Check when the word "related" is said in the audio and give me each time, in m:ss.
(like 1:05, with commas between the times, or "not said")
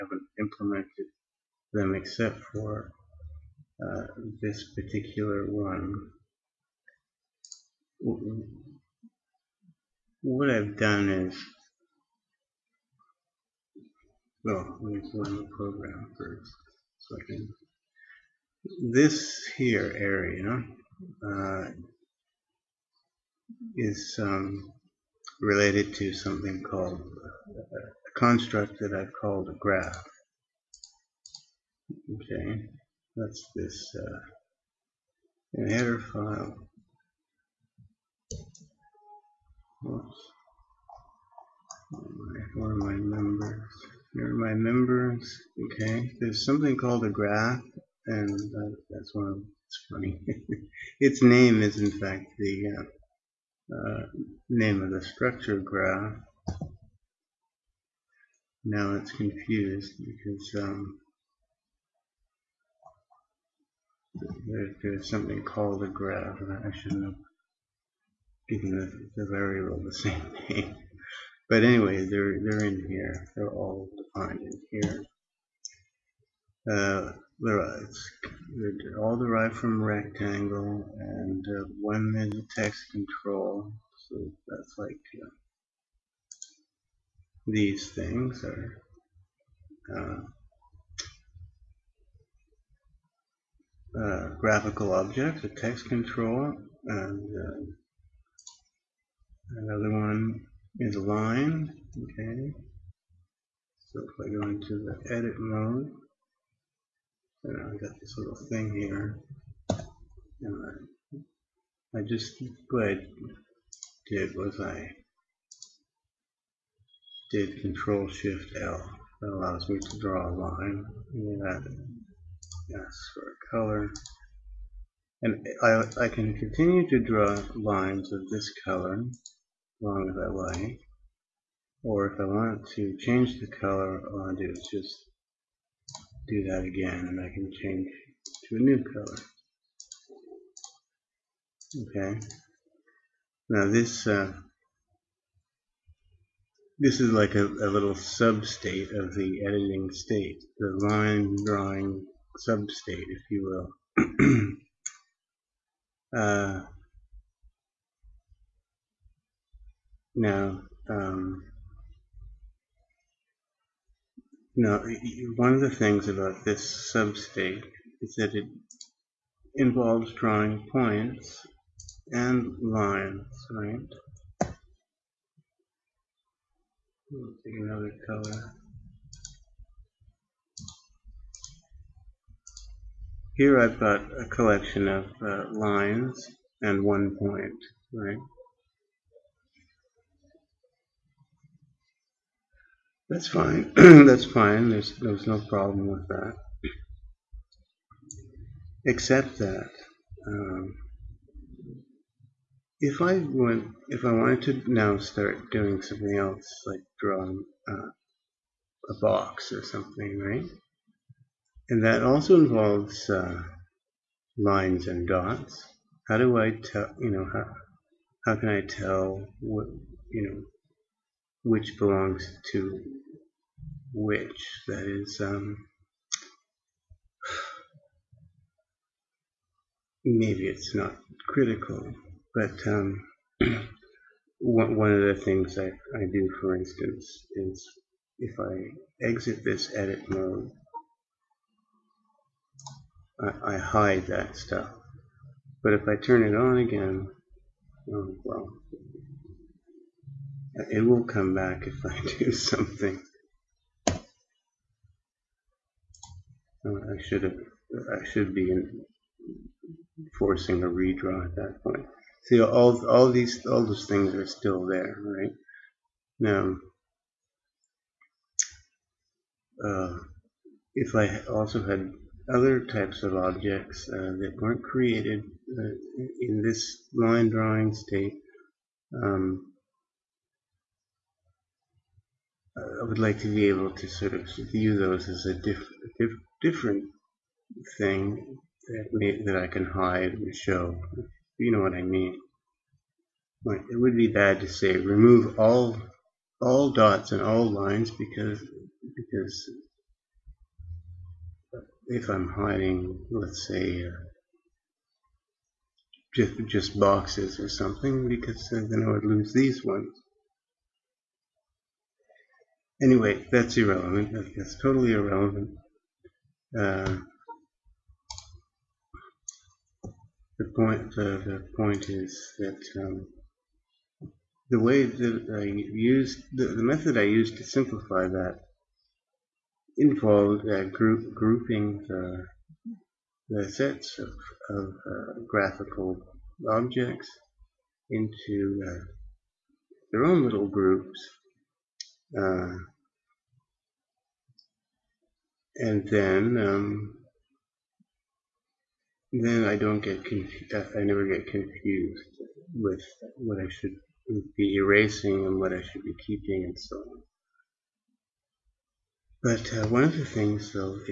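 0:25.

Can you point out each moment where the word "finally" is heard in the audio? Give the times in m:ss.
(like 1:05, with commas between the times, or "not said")
not said.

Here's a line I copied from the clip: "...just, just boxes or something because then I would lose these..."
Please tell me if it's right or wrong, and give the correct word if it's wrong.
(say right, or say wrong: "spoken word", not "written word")
right.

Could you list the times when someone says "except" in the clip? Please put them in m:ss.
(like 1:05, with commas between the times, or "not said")
0:01, 3:18.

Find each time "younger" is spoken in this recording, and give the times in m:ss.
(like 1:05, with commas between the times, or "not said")
not said.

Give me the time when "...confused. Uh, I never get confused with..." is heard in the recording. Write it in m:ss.
5:50.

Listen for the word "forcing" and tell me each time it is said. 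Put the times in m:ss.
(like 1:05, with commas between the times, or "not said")
4:20.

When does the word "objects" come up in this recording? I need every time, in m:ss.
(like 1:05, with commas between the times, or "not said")
1:34, 4:33, 5:36.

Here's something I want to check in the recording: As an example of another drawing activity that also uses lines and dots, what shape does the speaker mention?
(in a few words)
a box.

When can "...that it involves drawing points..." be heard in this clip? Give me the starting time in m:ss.
2:48.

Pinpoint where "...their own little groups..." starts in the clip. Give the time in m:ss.
5:39.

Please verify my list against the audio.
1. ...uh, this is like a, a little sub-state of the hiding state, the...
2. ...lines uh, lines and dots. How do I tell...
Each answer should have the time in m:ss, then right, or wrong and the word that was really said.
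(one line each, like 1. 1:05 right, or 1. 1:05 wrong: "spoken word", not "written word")
1. 2:24 wrong: "editing", not "hiding"
2. 3:32 wrong: "involves", not "lines".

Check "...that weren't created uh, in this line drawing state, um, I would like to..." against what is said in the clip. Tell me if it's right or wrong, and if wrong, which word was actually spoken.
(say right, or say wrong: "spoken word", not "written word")
right.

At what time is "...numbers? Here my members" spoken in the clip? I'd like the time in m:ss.
0:42.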